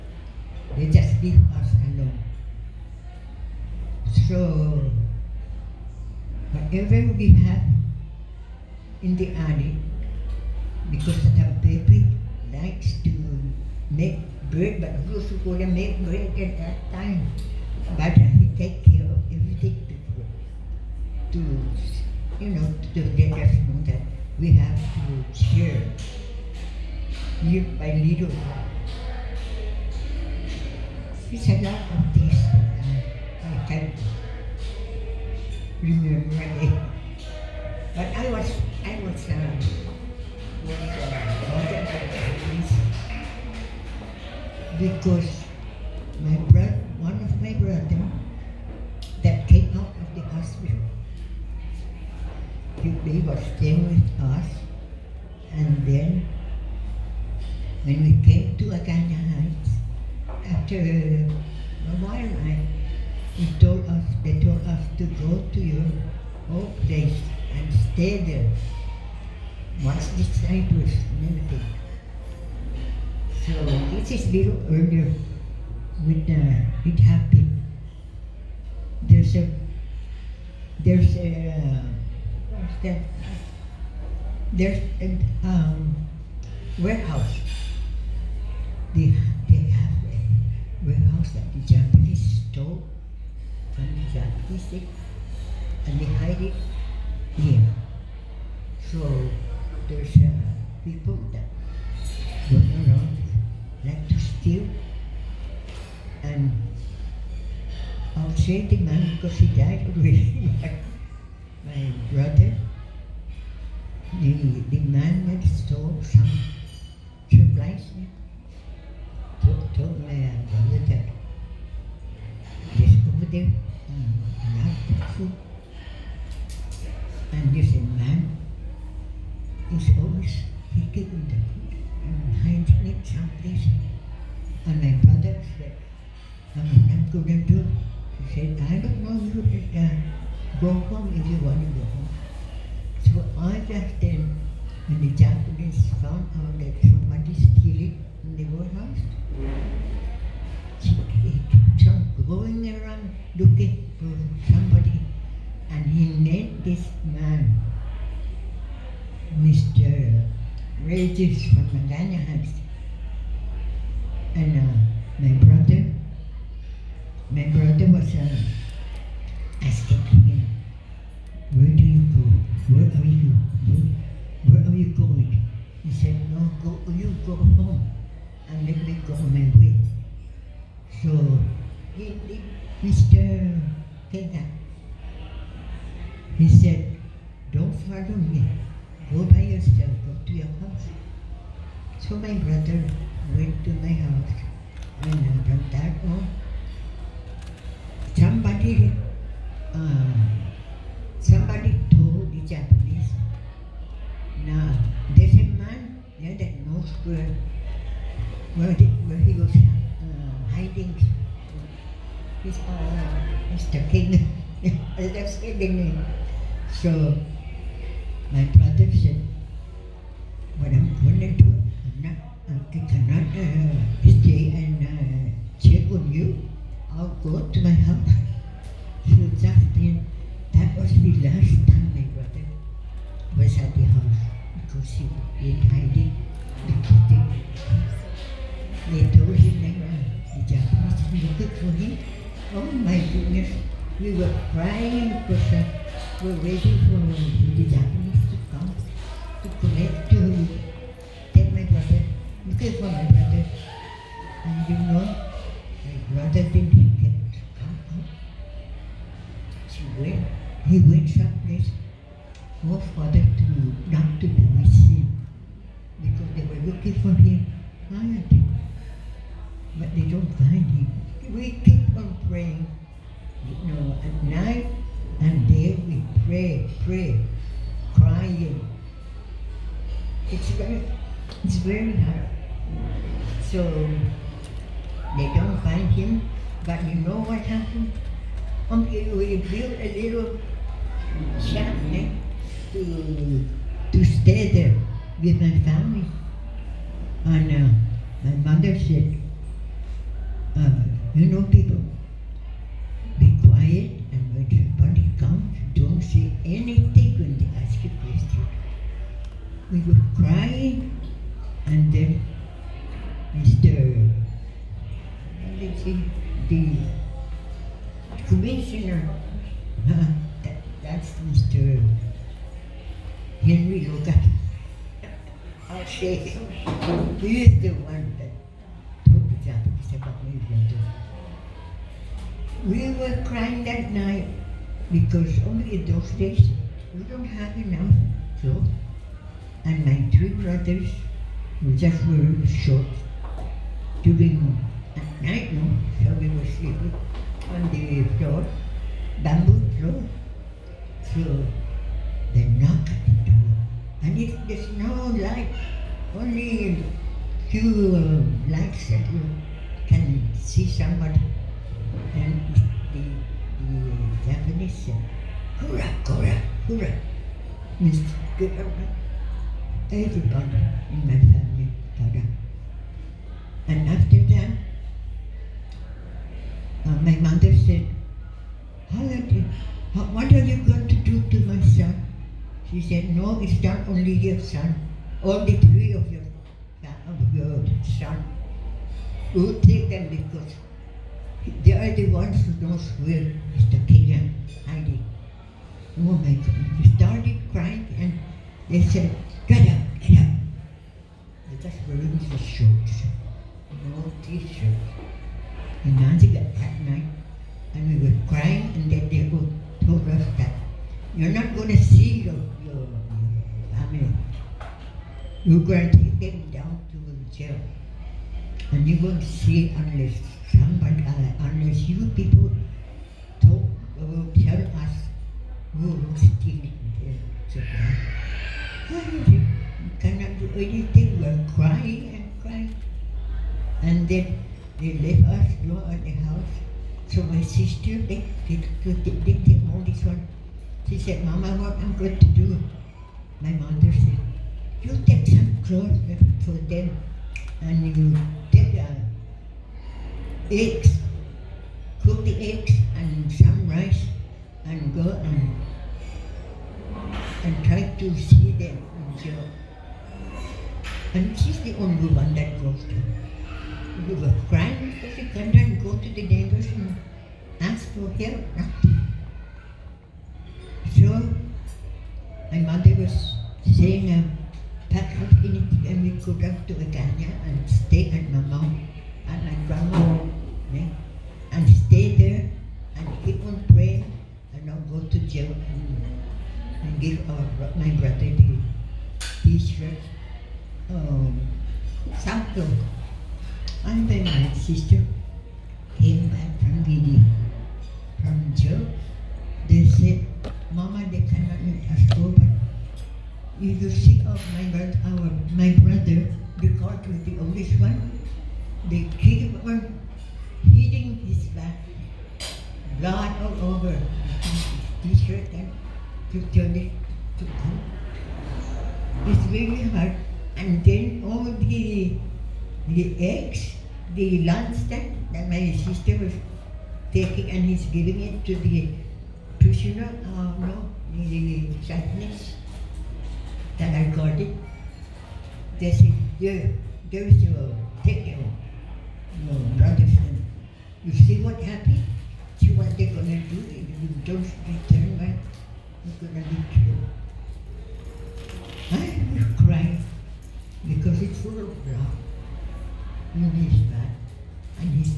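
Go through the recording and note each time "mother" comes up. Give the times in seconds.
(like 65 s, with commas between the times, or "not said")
298 s, 377 s, 443 s, 472 s.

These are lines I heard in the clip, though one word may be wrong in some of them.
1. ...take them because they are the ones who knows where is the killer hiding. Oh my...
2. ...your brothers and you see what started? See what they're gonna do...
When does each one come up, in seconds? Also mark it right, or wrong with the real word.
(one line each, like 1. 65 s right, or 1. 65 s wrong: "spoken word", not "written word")
1. 389 s right
2. 539 s wrong: "happened", not "started".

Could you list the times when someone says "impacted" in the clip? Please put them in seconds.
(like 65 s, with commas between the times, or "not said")
not said.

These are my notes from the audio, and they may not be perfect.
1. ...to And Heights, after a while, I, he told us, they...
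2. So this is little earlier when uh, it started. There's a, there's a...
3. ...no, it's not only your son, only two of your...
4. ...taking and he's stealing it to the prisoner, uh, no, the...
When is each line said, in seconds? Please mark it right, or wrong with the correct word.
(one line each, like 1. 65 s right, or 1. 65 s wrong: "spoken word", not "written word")
1. 58 s wrong: "Agana", not "And"
2. 73 s wrong: "happened", not "started"
3. 383 s wrong: "three", not "two"
4. 527 s wrong: "giving", not "stealing".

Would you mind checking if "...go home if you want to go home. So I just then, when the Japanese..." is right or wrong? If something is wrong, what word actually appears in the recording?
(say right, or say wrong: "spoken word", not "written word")
right.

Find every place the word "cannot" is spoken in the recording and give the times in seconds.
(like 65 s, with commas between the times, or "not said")
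222 s, 430 s.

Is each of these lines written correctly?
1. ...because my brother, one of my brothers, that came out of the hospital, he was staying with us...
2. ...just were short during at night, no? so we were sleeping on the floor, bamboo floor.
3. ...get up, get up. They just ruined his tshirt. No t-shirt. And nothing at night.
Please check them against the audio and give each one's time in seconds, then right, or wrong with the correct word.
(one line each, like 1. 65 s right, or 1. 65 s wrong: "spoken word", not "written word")
1. 44 s right
2. 341 s right
3. 399 s wrong: "shirt", not "tshirt".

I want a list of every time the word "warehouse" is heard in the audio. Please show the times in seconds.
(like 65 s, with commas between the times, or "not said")
86 s, 90 s, 148 s.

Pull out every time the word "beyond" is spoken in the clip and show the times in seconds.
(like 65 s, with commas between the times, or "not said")
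not said.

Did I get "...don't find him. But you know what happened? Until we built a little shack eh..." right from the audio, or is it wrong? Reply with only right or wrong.
right.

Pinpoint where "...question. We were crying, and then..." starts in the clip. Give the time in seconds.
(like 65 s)
308 s.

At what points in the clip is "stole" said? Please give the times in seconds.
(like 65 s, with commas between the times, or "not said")
92 s, 115 s.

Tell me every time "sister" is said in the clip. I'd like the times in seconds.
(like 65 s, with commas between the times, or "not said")
437 s, 525 s.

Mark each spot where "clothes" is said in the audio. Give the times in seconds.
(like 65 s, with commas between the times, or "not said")
445 s.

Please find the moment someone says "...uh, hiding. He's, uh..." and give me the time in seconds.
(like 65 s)
209 s.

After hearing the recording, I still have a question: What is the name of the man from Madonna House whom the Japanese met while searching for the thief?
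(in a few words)
Mr. Regis.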